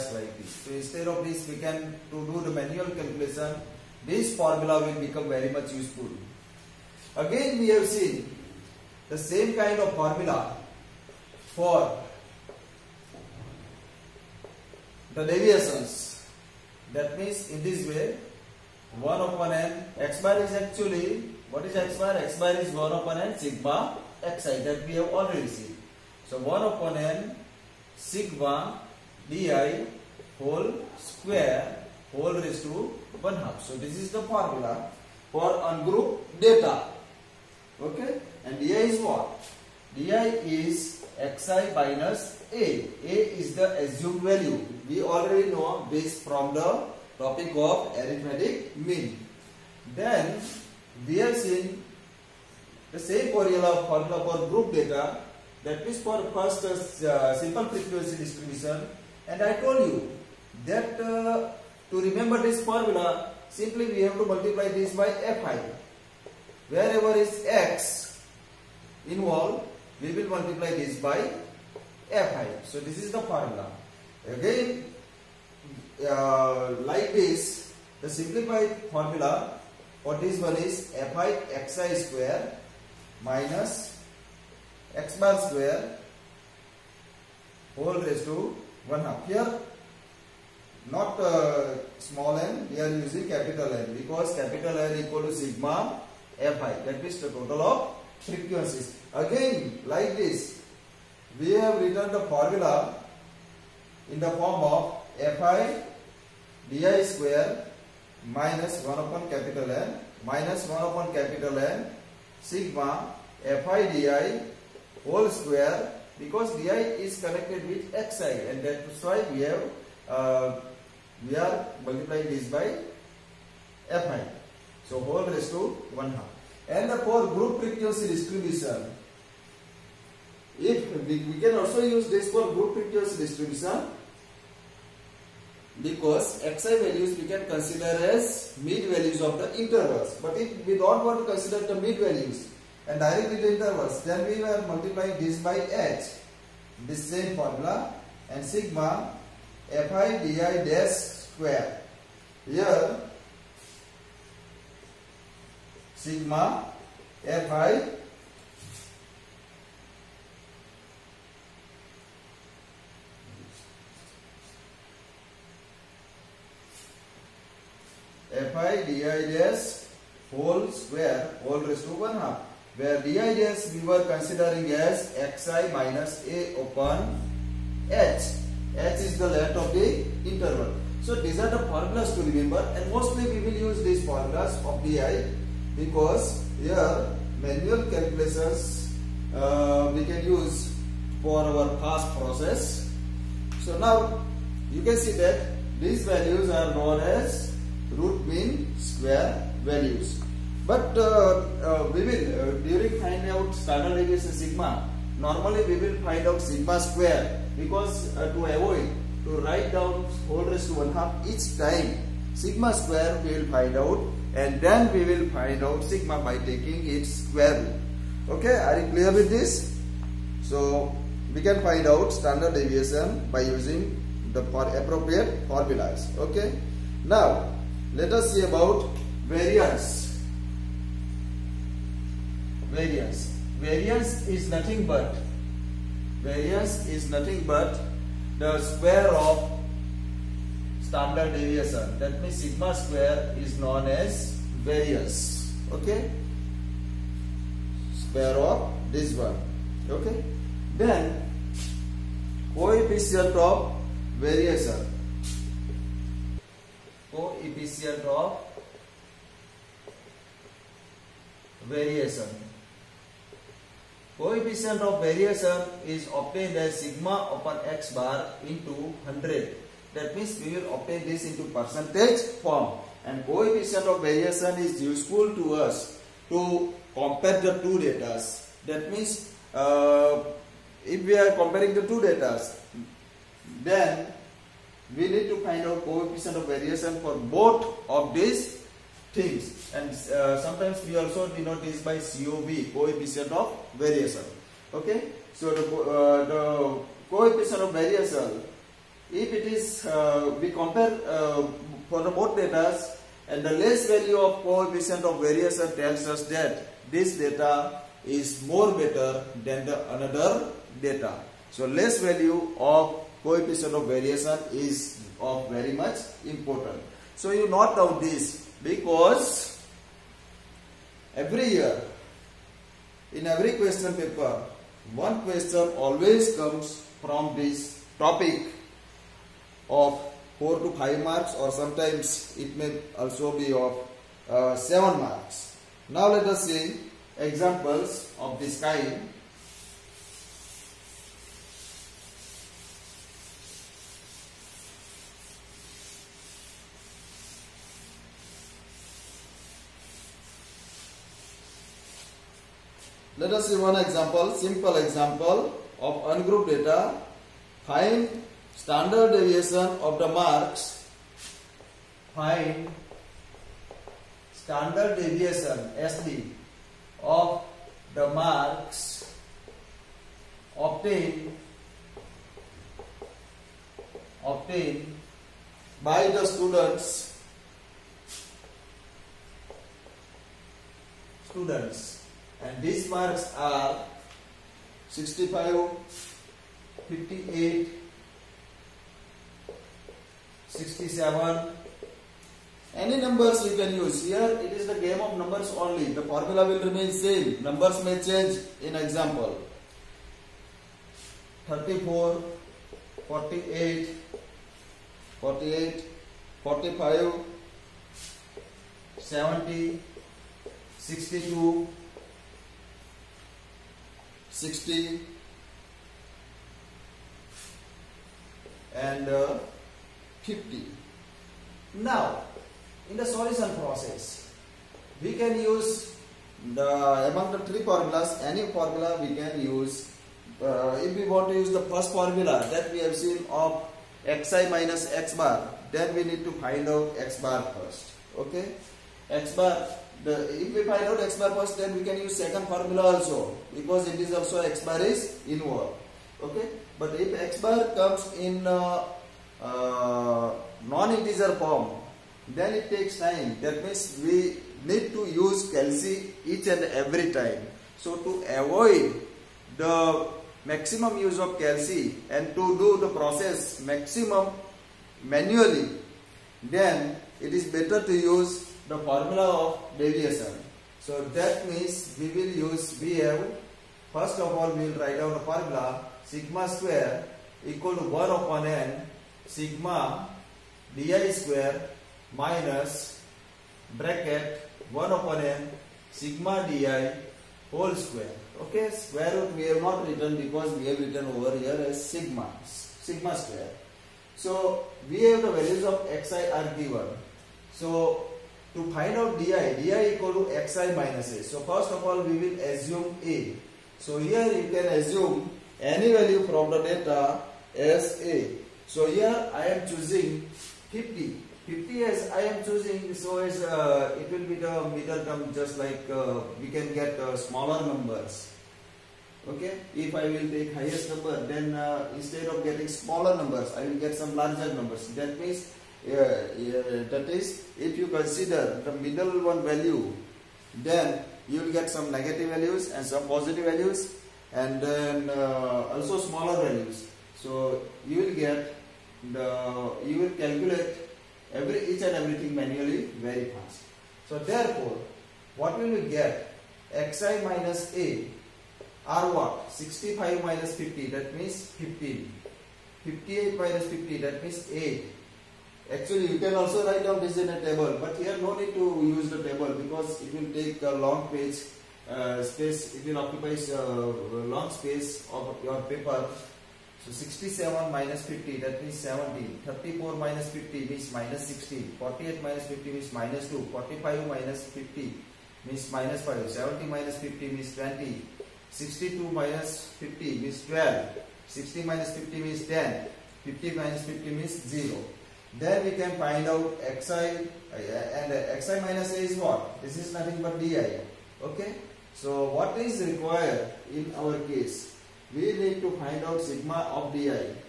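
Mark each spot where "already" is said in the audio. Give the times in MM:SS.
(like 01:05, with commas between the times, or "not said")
00:25, 00:45.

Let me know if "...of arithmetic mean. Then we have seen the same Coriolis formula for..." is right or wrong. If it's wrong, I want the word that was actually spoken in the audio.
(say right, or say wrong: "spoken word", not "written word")
right.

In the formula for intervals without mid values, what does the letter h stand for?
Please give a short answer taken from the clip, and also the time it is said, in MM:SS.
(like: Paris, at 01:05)
length of the interval, at 02:59.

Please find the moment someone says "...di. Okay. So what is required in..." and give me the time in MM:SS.
09:50.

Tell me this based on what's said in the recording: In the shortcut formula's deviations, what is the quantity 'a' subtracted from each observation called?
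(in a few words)
assumed value.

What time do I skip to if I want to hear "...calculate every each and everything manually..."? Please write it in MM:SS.
09:00.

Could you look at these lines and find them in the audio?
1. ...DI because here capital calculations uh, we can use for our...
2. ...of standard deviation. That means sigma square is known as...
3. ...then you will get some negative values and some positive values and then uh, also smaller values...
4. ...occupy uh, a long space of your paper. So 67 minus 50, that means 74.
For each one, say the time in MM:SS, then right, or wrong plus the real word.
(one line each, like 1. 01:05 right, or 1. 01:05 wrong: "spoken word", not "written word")
1. 03:04 wrong: "manual", not "capital"
2. 03:59 right
3. 08:50 right
4. 09:22 wrong: "70", not "74".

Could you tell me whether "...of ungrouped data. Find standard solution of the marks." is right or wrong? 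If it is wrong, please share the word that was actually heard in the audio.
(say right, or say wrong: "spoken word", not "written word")
wrong: "deviation", not "solution".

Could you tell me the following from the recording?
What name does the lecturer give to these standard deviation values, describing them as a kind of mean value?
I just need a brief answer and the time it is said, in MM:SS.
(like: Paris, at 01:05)
root mean square values, at 03:17.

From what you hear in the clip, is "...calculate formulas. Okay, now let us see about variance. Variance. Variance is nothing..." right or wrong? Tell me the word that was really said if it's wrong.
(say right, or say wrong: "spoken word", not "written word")
wrong: "appropriate", not "calculate".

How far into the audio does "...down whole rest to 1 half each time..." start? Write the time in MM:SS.
03:29.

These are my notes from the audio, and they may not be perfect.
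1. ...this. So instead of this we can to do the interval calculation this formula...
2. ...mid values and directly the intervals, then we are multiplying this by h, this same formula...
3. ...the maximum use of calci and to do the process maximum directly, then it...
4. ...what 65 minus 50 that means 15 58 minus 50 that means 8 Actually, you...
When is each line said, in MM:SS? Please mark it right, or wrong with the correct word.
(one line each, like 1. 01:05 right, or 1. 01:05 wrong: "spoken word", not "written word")
1. 00:00 wrong: "manual", not "interval"
2. 02:21 right
3. 07:39 wrong: "manually", not "directly"
4. 09:09 right.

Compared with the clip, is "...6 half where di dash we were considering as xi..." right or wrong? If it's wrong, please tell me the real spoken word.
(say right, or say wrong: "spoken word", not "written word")
wrong: "1", not "6".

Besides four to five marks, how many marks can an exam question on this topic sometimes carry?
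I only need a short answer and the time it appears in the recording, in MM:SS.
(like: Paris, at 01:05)
7, at 05:34.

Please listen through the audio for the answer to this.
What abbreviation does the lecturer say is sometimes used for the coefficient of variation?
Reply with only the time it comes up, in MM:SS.
04:51.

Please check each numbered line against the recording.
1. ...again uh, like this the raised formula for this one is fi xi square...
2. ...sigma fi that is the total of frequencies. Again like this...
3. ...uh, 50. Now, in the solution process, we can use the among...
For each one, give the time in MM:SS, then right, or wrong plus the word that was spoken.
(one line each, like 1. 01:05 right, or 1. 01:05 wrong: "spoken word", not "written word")
1. 01:14 wrong: "simplified", not "raised"
2. 01:35 right
3. 06:59 right.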